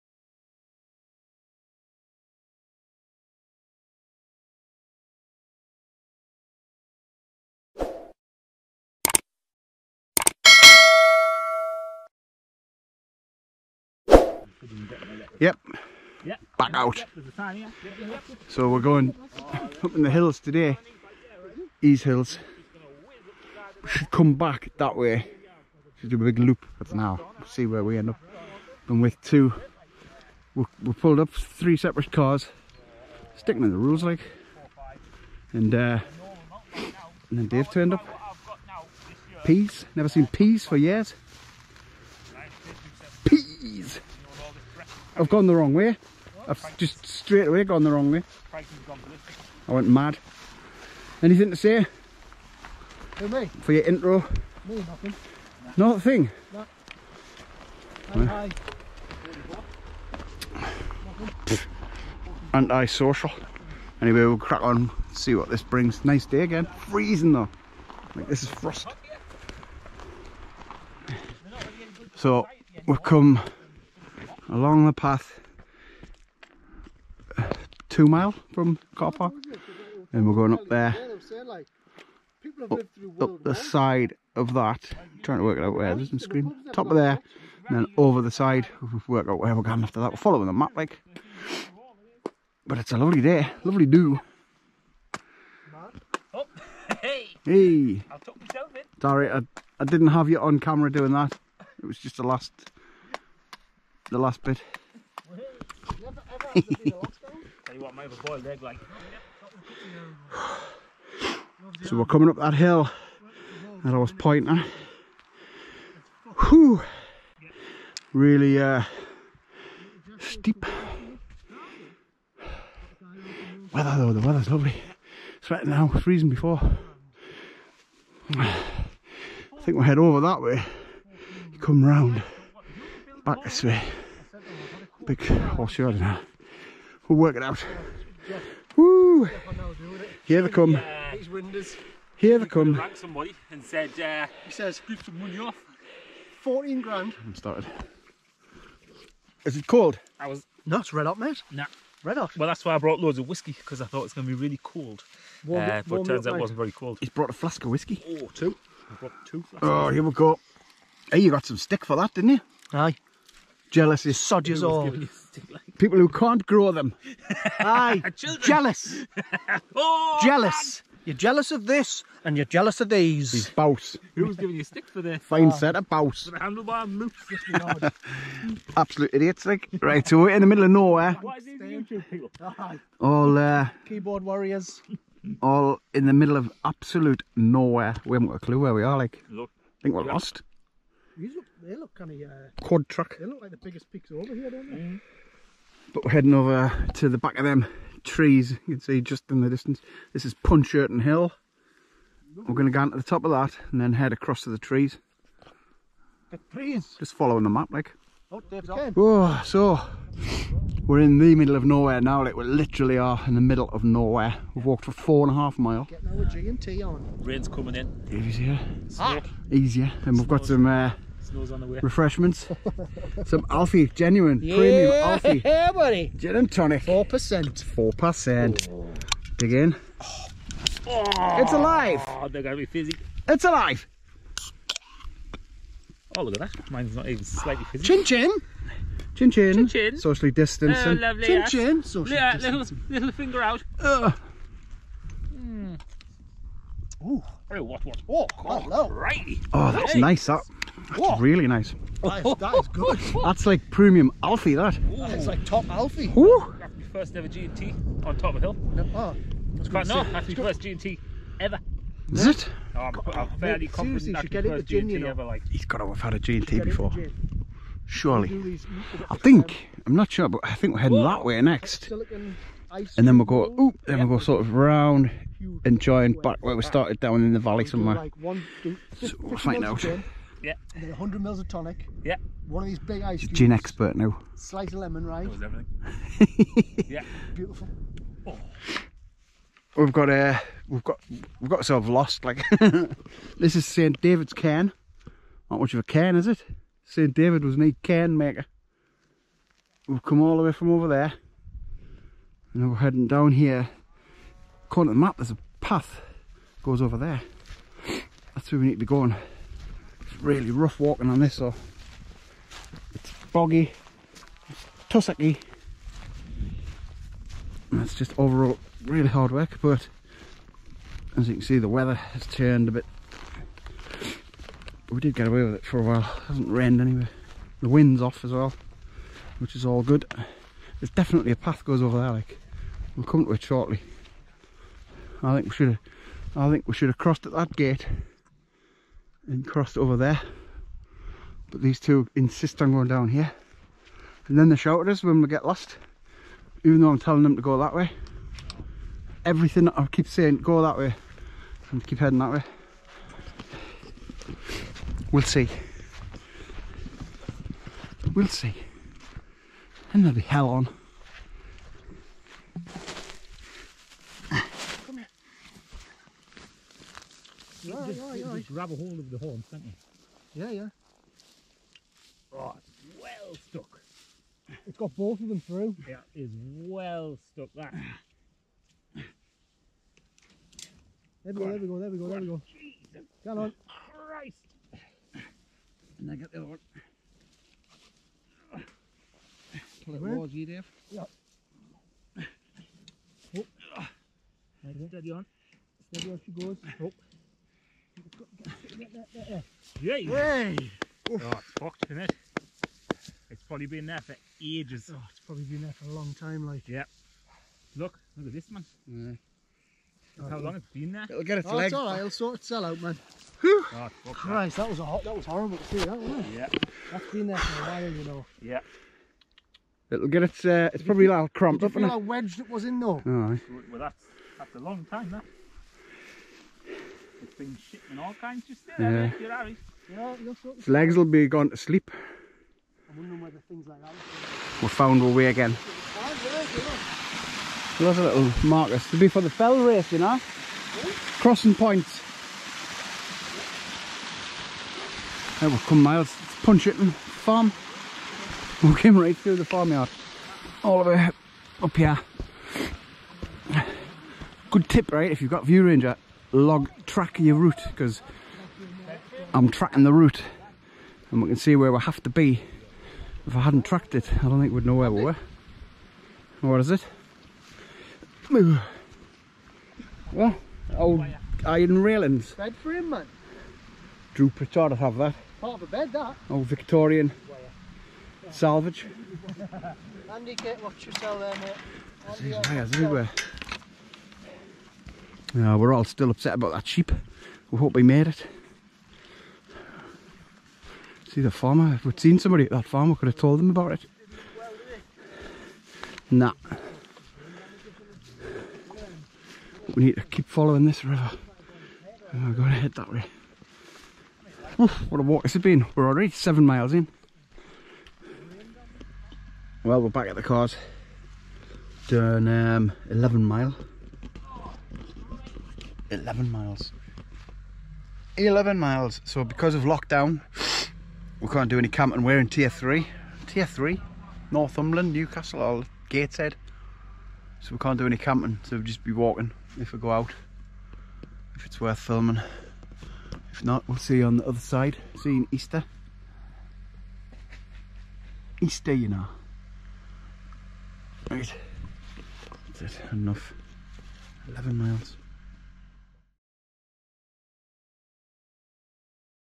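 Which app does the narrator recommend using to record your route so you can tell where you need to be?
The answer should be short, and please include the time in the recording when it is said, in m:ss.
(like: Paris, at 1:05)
ViewRanger, at 7:35.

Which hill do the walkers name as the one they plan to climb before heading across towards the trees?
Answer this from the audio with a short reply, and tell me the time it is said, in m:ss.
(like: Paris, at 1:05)
Puncherton Hill, at 3:20.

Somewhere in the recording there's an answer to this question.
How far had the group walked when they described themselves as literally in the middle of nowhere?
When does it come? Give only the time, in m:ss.
3:34.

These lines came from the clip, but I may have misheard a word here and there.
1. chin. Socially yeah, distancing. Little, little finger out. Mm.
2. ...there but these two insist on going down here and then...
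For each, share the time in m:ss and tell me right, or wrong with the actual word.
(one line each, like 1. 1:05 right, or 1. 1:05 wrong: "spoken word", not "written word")
1. 4:01 right
2. 5:39 right.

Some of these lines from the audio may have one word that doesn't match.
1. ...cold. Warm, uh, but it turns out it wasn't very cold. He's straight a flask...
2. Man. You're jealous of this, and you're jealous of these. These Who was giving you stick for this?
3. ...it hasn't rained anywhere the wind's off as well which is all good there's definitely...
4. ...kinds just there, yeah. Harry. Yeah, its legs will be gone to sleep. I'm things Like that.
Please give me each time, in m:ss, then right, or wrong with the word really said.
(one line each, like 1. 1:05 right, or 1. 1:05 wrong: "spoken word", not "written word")
1. 2:34 wrong: "brought", not "straight"
2. 2:50 right
3. 5:25 right
4. 7:08 right.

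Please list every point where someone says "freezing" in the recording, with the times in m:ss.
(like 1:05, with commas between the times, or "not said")
1:06, 2:05.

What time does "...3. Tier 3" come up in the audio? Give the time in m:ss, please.
8:42.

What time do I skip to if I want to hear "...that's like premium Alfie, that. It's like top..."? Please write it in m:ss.
4:13.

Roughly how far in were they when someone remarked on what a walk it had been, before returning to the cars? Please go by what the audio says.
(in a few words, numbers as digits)
7 miles.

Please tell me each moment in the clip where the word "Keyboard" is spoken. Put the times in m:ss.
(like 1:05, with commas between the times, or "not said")
3:03.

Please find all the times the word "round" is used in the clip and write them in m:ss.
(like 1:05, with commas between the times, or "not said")
2:11, 4:34.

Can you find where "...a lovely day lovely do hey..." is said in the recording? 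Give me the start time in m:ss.
1:32.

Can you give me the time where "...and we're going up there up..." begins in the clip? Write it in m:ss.
1:20.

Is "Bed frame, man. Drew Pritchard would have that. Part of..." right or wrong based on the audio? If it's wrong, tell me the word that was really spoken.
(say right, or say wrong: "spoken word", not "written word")
right.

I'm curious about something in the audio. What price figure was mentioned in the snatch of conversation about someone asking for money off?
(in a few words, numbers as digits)
14 grand.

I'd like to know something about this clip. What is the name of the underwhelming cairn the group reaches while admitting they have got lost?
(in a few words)
St David's Cairn.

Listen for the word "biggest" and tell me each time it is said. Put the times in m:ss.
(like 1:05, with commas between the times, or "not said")
3:13.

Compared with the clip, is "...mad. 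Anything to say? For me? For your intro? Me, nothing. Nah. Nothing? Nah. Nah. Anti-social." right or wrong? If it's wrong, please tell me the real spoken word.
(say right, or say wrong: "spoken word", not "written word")
right.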